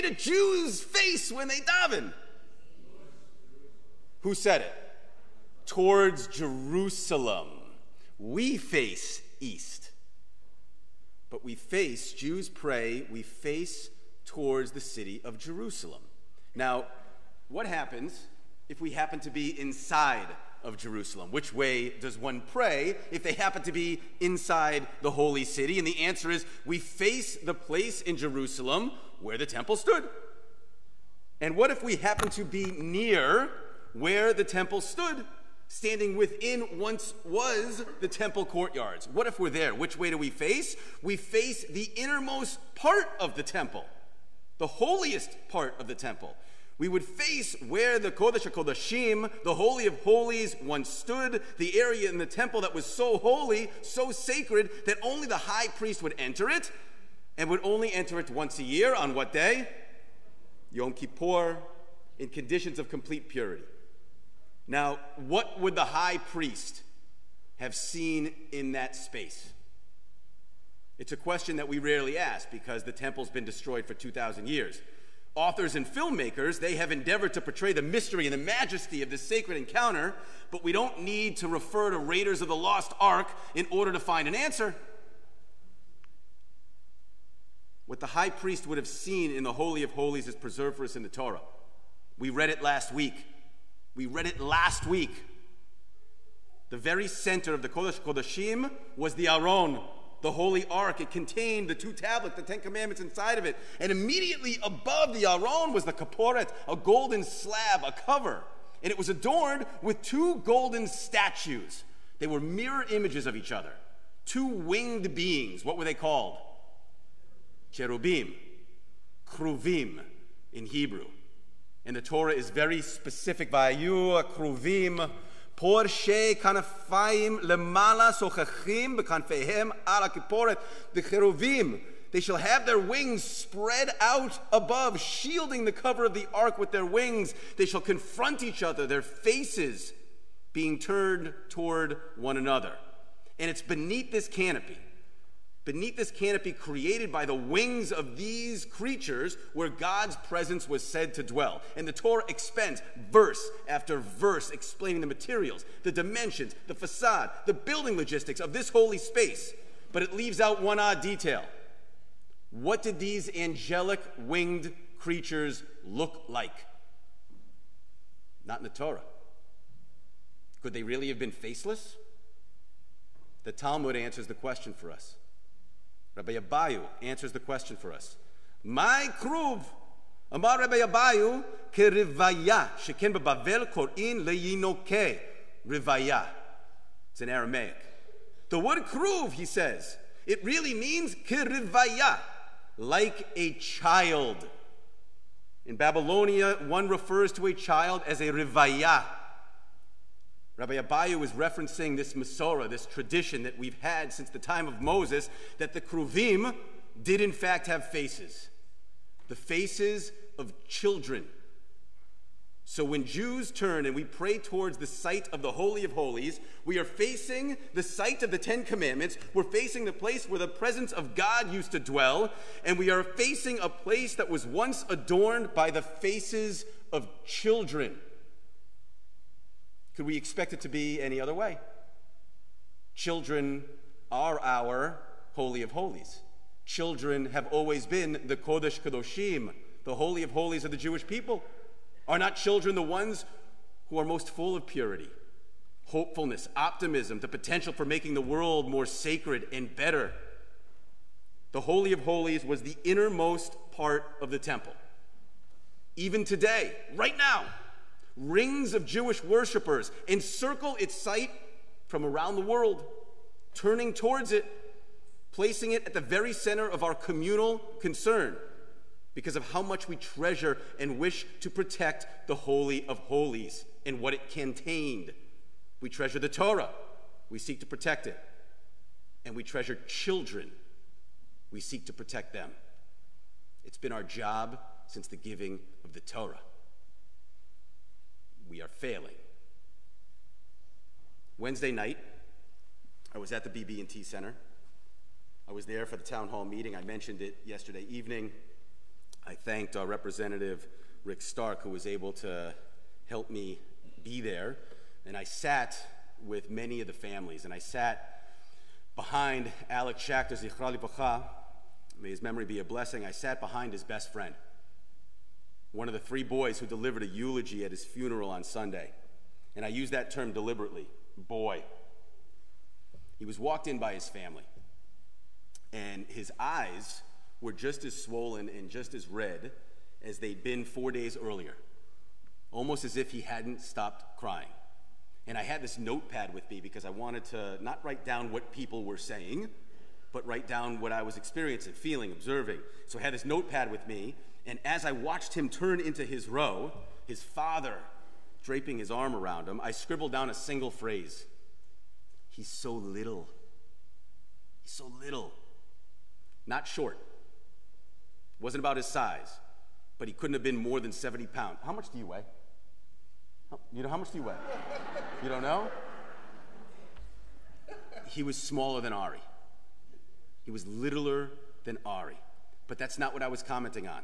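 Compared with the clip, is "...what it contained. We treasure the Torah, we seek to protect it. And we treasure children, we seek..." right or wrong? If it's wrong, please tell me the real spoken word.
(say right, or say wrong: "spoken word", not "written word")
right.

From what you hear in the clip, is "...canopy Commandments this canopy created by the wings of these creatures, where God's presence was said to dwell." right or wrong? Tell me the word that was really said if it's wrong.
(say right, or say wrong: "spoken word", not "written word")
wrong: "Beneath", not "Commandments".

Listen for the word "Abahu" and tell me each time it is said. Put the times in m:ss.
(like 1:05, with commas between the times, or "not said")
2:56, 3:00, 3:20.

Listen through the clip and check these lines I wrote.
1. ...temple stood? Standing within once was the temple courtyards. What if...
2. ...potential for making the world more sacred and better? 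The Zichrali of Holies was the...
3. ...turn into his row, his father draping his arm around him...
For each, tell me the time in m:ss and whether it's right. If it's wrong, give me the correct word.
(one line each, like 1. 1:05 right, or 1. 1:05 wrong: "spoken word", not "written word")
1. 0:34 right
2. 4:07 wrong: "Holy", not "Zichrali"
3. 5:45 right.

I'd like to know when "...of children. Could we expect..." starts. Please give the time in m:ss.
3:46.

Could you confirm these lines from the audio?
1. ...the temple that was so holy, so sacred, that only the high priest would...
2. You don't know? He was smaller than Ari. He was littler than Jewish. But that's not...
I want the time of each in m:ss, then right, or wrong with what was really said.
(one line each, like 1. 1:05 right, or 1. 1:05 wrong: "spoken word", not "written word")
1. 0:52 right
2. 6:05 wrong: "Ari", not "Jewish".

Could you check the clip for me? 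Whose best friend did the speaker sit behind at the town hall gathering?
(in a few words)
Alex Schachter.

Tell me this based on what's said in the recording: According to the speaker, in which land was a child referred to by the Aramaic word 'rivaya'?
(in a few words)
Babylonia.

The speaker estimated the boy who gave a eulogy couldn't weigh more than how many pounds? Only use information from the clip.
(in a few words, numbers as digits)
70.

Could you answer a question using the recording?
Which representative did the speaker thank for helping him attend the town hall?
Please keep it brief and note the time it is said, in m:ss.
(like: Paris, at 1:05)
Rick Stark, at 5:01.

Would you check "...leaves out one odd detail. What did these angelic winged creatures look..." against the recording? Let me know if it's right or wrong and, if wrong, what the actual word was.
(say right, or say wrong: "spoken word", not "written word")
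right.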